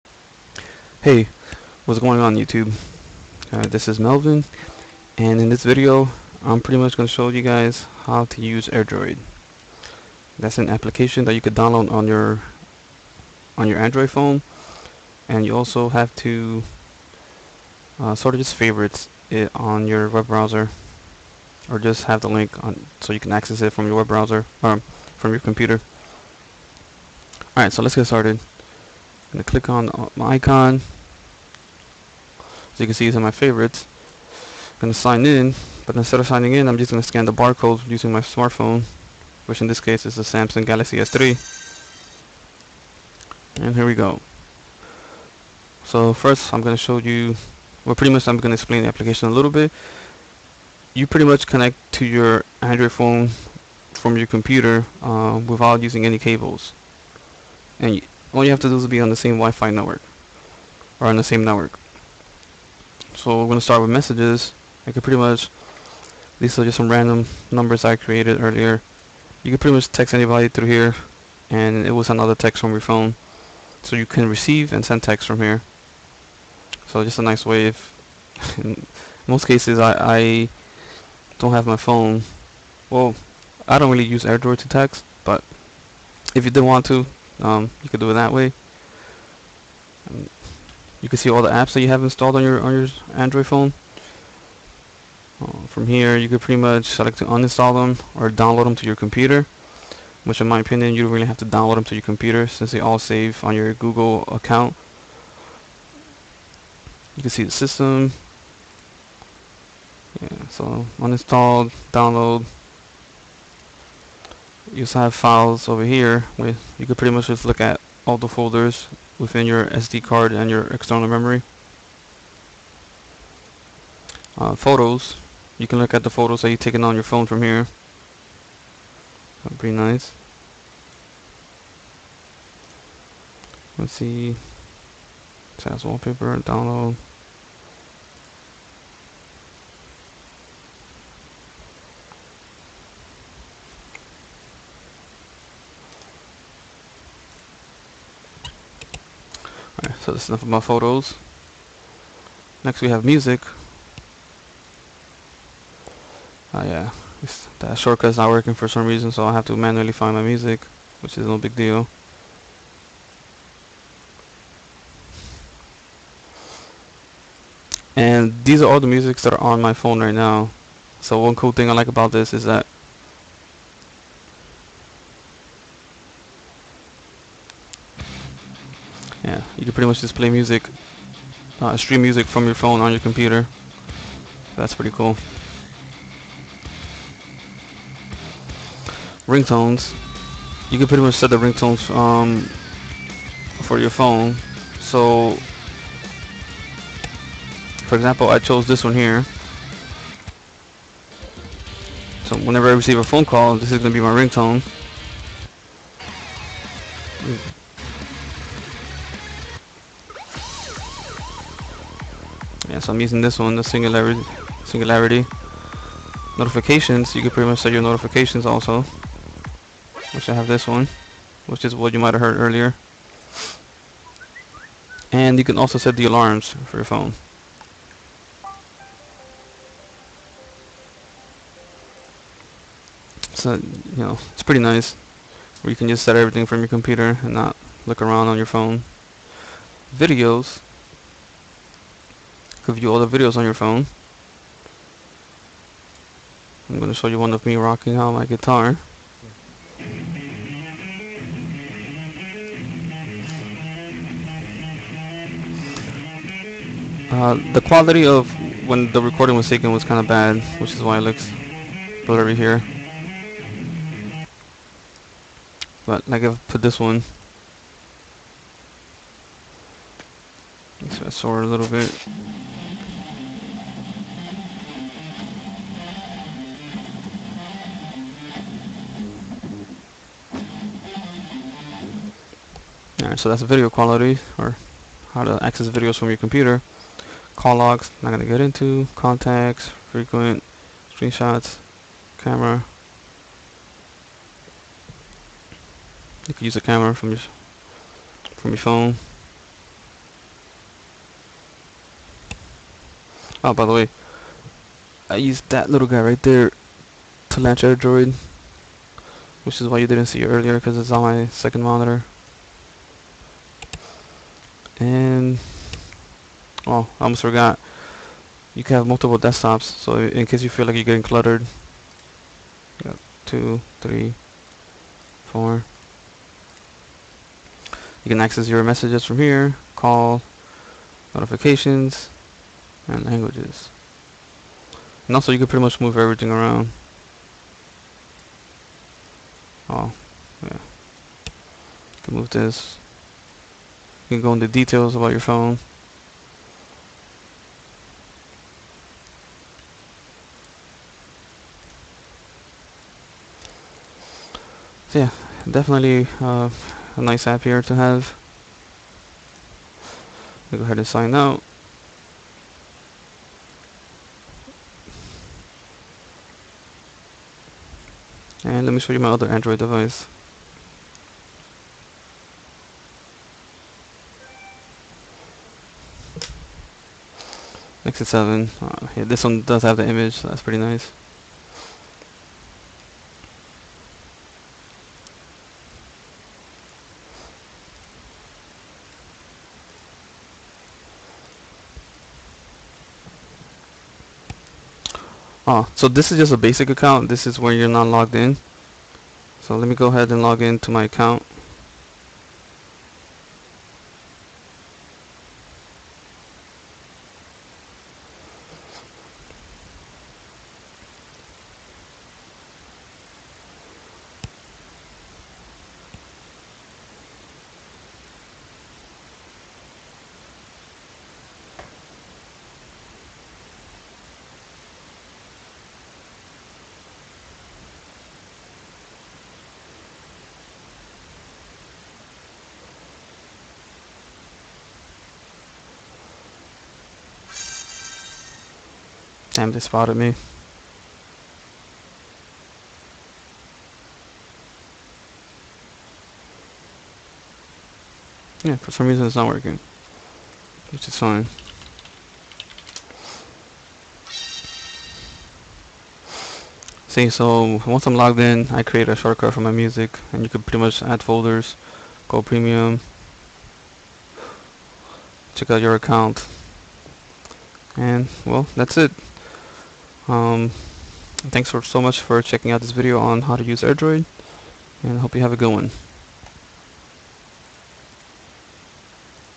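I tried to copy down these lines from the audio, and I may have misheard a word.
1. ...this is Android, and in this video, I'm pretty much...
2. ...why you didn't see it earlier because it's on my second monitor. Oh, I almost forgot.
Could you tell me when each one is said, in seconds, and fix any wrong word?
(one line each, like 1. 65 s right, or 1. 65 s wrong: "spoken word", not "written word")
1. 3 s wrong: "Melvin", not "Android"
2. 309 s right.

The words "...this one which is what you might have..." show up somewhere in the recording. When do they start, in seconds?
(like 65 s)
220 s.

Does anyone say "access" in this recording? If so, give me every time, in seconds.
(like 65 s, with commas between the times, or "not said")
23 s, 285 s, 328 s.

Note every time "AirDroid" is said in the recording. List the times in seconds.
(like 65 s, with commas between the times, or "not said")
8 s, 84 s, 307 s, 473 s.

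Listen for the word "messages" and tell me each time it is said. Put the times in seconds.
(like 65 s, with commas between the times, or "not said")
63 s, 328 s.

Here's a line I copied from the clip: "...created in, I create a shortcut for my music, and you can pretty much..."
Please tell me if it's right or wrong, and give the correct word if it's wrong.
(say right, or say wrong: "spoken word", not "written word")
wrong: "logged", not "created".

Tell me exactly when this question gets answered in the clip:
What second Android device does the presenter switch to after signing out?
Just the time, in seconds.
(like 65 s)
377 s.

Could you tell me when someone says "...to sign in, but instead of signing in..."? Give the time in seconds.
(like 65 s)
34 s.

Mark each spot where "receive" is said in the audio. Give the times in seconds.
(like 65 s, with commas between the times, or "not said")
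74 s, 202 s.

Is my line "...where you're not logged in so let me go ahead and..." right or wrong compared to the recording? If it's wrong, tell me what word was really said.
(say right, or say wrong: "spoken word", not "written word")
right.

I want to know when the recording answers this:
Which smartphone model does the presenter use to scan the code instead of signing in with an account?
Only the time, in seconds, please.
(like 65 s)
40 s.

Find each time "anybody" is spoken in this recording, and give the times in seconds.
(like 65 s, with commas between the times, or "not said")
70 s.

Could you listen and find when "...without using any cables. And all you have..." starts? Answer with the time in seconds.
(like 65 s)
55 s.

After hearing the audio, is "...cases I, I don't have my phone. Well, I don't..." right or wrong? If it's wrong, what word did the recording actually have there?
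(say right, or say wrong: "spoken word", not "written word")
right.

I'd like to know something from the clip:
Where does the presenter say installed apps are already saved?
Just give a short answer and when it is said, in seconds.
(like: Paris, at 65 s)
Google account, at 103 s.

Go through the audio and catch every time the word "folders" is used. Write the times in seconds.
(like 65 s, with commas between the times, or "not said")
118 s, 461 s.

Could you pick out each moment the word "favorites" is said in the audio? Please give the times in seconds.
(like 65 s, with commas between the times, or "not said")
18 s, 33 s.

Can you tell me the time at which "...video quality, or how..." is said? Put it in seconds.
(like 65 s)
283 s.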